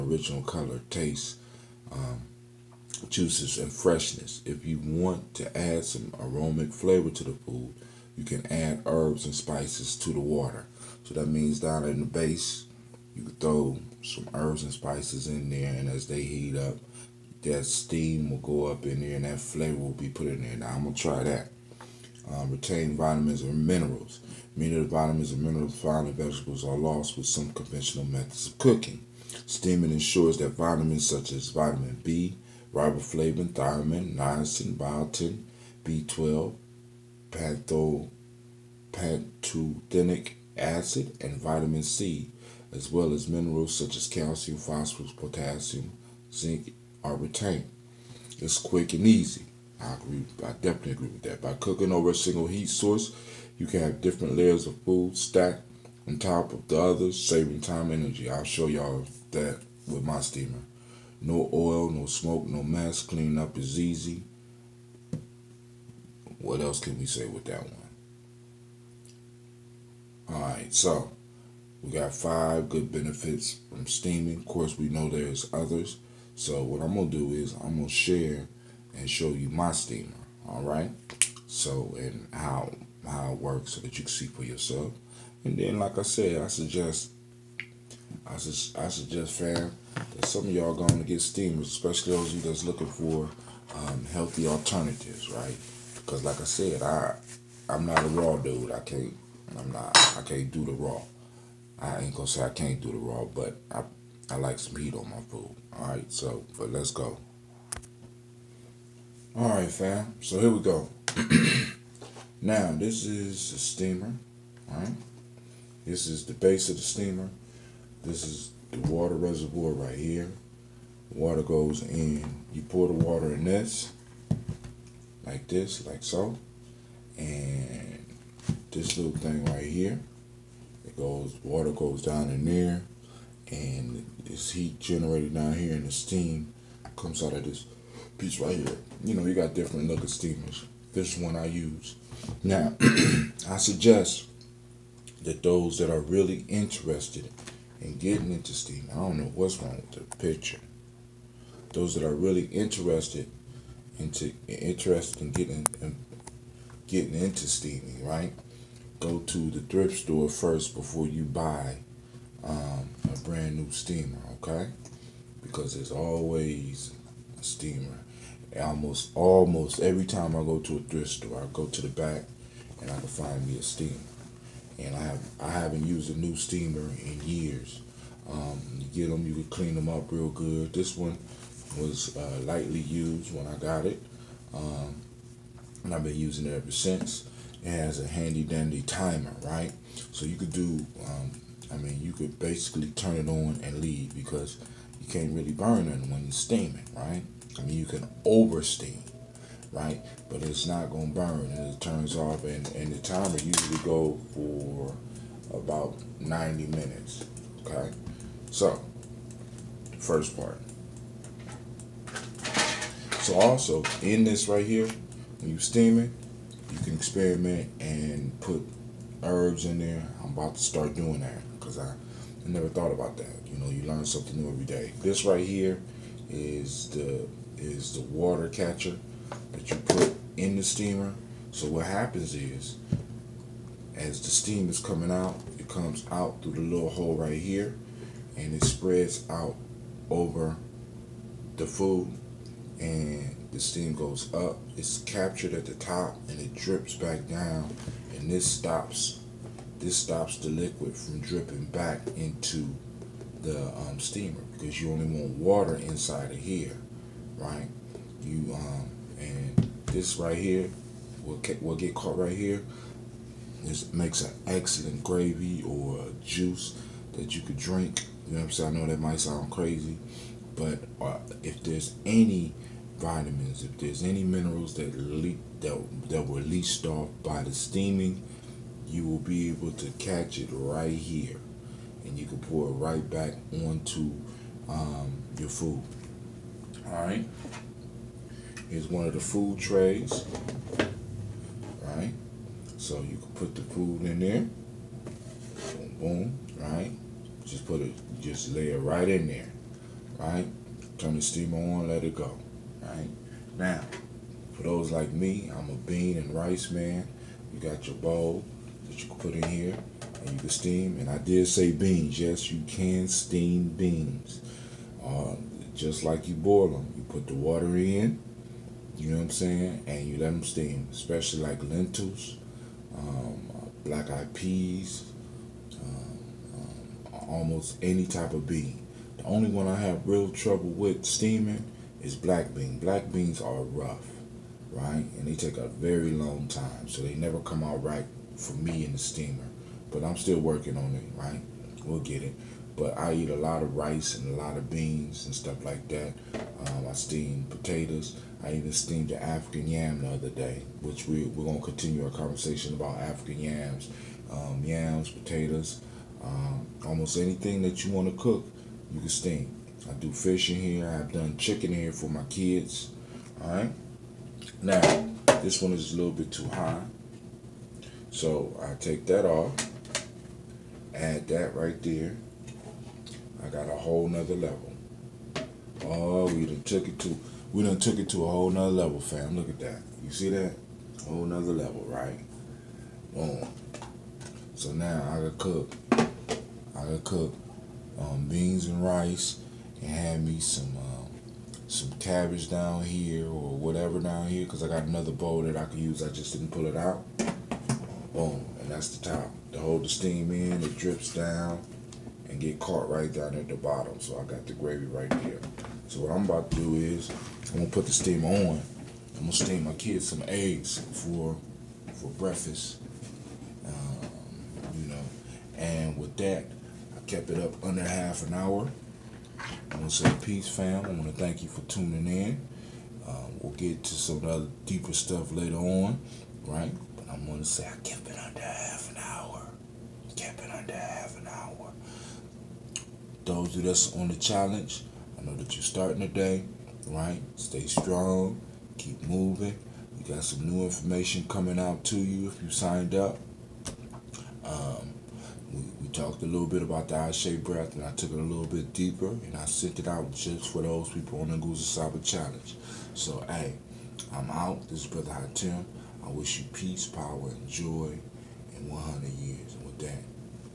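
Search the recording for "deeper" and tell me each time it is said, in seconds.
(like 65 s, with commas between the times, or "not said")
424 s, 448 s.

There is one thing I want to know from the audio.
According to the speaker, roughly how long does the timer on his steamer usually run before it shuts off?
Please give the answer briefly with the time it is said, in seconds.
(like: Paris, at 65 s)
90 minutes, at 206 s.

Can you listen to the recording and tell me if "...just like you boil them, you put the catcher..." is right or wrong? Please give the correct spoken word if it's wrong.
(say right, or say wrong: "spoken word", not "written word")
wrong: "water", not "catcher".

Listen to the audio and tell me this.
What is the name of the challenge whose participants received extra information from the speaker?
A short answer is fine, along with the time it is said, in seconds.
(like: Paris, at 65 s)
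Nguzo Saba Challenge, at 451 s.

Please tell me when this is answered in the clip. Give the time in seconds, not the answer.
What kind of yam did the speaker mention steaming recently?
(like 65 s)
349 s.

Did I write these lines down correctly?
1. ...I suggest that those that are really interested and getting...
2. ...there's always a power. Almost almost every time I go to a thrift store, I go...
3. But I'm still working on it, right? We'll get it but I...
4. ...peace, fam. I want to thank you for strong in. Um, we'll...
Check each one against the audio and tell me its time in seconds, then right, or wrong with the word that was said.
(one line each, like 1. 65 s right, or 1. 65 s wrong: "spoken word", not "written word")
1. 143 s right
2. 165 s wrong: "steamer", not "power"
3. 339 s right
4. 420 s wrong: "tuning", not "strong".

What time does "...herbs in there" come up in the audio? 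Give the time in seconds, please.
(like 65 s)
219 s.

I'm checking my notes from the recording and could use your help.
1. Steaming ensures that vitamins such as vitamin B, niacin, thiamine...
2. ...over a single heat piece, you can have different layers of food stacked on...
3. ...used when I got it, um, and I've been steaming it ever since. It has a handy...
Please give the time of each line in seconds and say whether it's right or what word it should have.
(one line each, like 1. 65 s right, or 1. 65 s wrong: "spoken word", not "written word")
1. 29 s wrong: "riboflavin", not "niacin"
2. 51 s wrong: "source", not "piece"
3. 182 s wrong: "using", not "steaming".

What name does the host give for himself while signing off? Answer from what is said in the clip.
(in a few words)
Brother Haatim.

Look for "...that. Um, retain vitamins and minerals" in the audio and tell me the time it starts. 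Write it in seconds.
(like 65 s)
21 s.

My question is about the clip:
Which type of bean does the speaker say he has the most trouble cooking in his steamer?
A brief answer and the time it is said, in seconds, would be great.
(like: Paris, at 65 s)
Black bean, at 332 s.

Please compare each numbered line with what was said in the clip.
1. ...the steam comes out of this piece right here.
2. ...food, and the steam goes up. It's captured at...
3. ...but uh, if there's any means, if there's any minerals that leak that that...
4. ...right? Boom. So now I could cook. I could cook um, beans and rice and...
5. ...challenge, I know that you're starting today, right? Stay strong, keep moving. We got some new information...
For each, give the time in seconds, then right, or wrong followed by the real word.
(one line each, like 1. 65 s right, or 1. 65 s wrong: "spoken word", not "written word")
1. 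135 s right
2. 241 s right
3. 270 s wrong: "vitamins", not "means"
4. 381 s right
5. 434 s right.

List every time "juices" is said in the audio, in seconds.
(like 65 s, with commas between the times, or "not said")
3 s, 266 s.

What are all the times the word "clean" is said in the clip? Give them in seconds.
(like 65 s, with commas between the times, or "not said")
63 s, 179 s.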